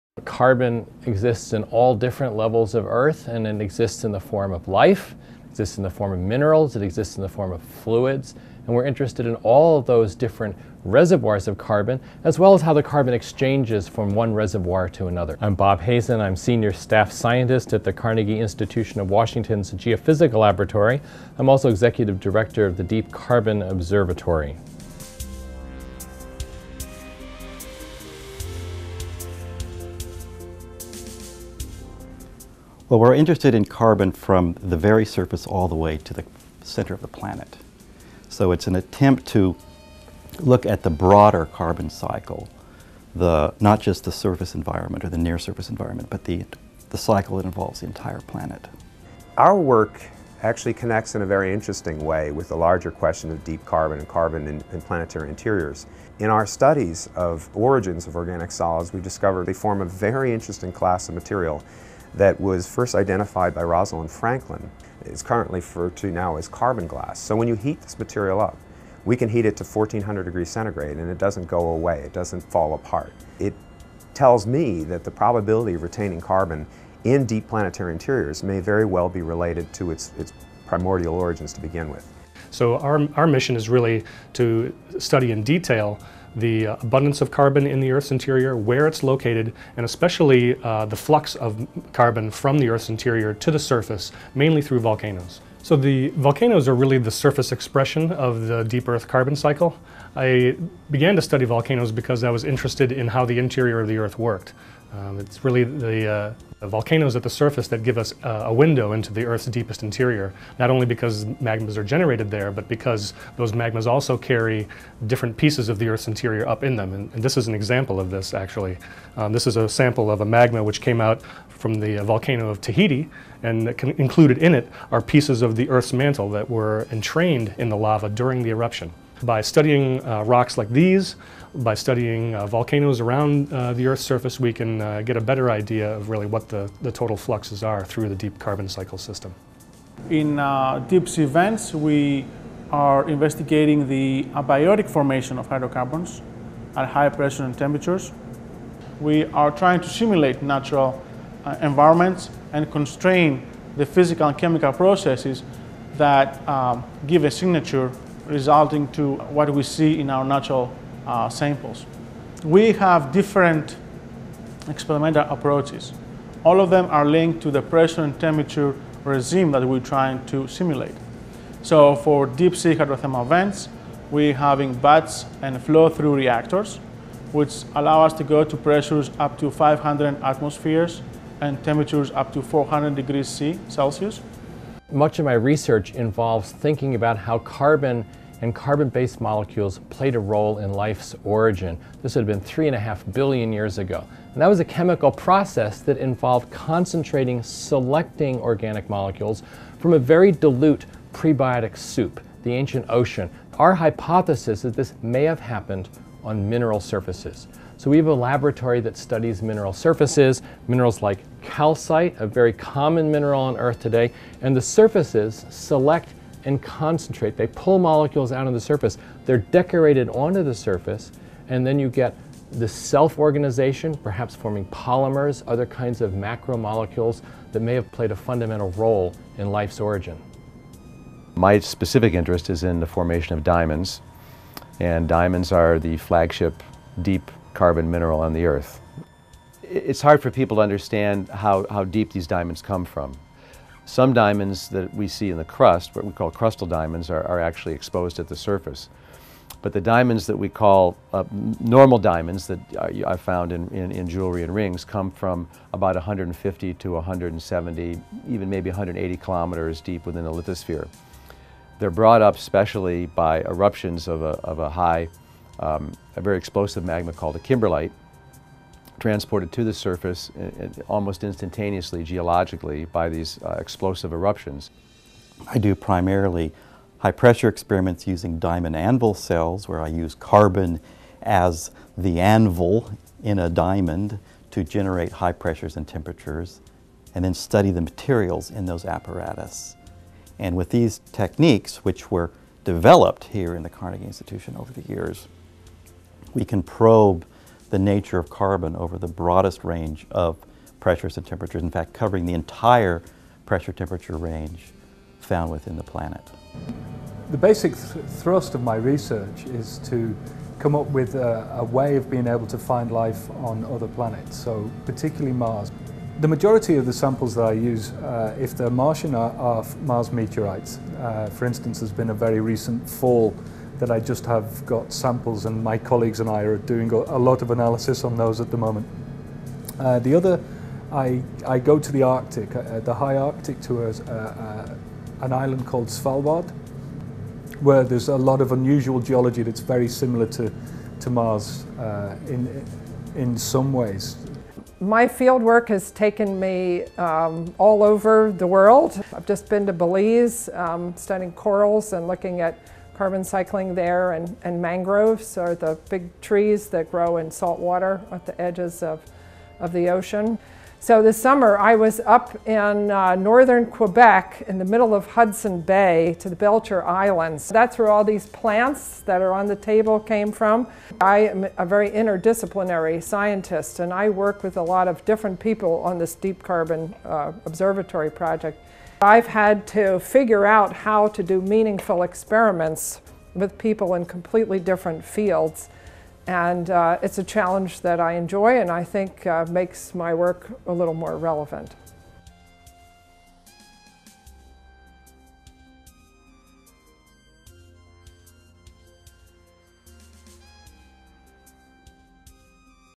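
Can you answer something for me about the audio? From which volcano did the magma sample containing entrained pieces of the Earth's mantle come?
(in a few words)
Tahiti.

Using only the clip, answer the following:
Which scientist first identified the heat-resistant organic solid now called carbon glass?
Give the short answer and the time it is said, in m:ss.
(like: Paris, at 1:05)
Rosalind Franklin, at 1:03.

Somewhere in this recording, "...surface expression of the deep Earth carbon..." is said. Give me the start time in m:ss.
1:37.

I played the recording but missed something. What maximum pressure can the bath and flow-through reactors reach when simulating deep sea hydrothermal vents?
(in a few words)
500 atmospheres.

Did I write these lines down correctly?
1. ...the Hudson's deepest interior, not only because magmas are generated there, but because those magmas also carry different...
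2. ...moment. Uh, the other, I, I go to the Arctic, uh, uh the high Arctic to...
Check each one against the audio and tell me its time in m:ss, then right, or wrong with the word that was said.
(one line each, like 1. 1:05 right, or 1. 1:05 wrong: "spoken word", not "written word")
1. 1:49 wrong: "Earth", not "Hudson"
2. 5:28 right.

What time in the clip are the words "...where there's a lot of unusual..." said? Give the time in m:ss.
5:37.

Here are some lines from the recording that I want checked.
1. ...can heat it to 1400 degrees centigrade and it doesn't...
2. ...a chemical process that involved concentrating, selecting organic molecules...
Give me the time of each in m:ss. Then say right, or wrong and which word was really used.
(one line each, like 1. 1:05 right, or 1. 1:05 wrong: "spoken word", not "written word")
1. 1:09 right
2. 3:14 right.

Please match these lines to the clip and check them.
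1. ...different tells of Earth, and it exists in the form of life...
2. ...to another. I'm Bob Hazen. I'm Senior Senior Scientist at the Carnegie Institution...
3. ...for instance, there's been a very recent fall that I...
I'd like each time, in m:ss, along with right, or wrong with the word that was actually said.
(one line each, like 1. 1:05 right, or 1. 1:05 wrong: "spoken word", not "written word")
1. 0:01 wrong: "levels", not "tells"
2. 0:14 wrong: "Staff", not "Senior"
3. 5:21 right.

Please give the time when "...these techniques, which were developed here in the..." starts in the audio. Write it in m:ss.
4:50.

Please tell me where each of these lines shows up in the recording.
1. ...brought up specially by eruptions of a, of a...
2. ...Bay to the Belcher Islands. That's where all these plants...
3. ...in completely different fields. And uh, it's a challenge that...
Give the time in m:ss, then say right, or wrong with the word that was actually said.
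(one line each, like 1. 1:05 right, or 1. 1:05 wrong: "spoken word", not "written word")
1. 4:21 right
2. 6:05 right
3. 6:23 right.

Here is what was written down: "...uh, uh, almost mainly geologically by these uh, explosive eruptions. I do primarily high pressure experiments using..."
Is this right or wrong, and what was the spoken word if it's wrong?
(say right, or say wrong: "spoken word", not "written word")
wrong: "instantaneously", not "mainly".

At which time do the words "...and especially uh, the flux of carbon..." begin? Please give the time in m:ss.
1:29.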